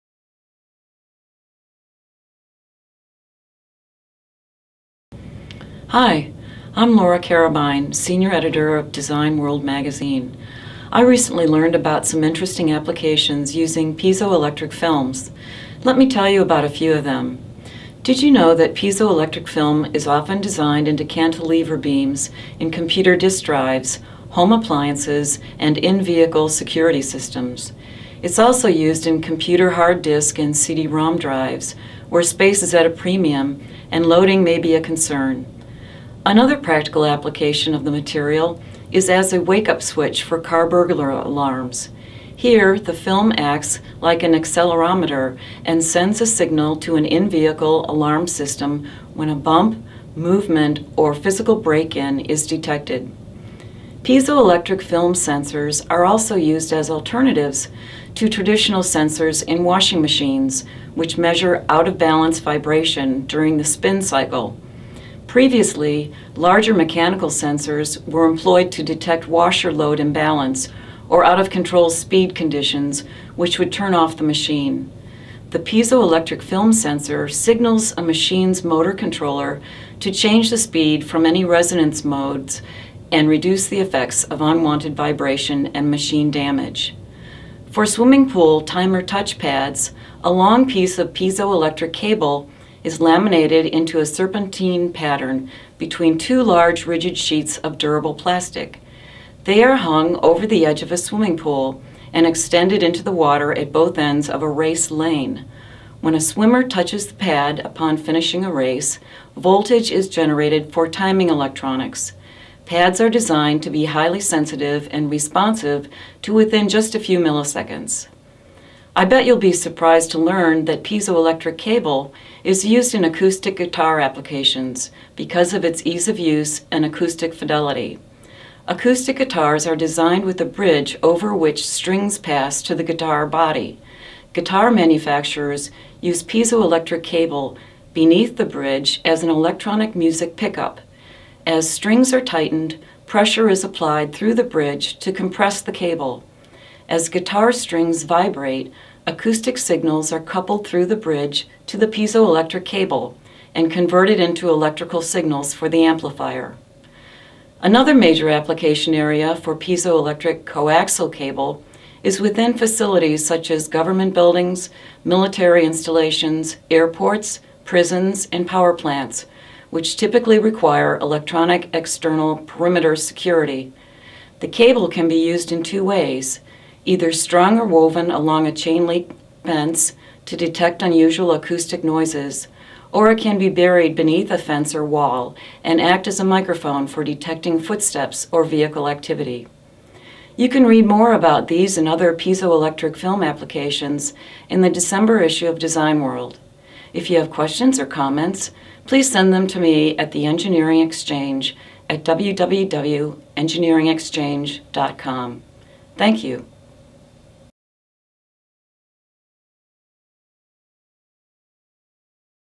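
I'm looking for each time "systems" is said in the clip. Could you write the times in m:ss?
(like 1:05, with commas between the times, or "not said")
0:27, 0:48.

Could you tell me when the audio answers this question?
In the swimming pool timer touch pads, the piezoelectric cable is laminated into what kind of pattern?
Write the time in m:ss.
1:34.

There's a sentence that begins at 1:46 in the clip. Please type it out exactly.
When a swimmer touches the pad upon finishing a race, voltage is generated for timing electronics.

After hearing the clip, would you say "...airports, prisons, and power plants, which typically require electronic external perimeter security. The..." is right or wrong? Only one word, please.
right.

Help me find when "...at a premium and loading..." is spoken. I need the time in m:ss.
0:32.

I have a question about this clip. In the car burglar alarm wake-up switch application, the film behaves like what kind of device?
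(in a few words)
Accelerometer.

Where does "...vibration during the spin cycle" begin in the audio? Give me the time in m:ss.
1:02.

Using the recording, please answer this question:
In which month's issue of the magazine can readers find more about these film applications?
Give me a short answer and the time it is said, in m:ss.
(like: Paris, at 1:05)
December, at 3:14.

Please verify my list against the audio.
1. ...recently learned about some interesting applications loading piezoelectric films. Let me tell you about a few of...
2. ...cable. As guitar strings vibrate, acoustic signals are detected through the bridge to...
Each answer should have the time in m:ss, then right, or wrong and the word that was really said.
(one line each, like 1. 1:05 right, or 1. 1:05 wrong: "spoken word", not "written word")
1. 0:11 wrong: "using", not "loading"
2. 2:25 wrong: "coupled", not "detected".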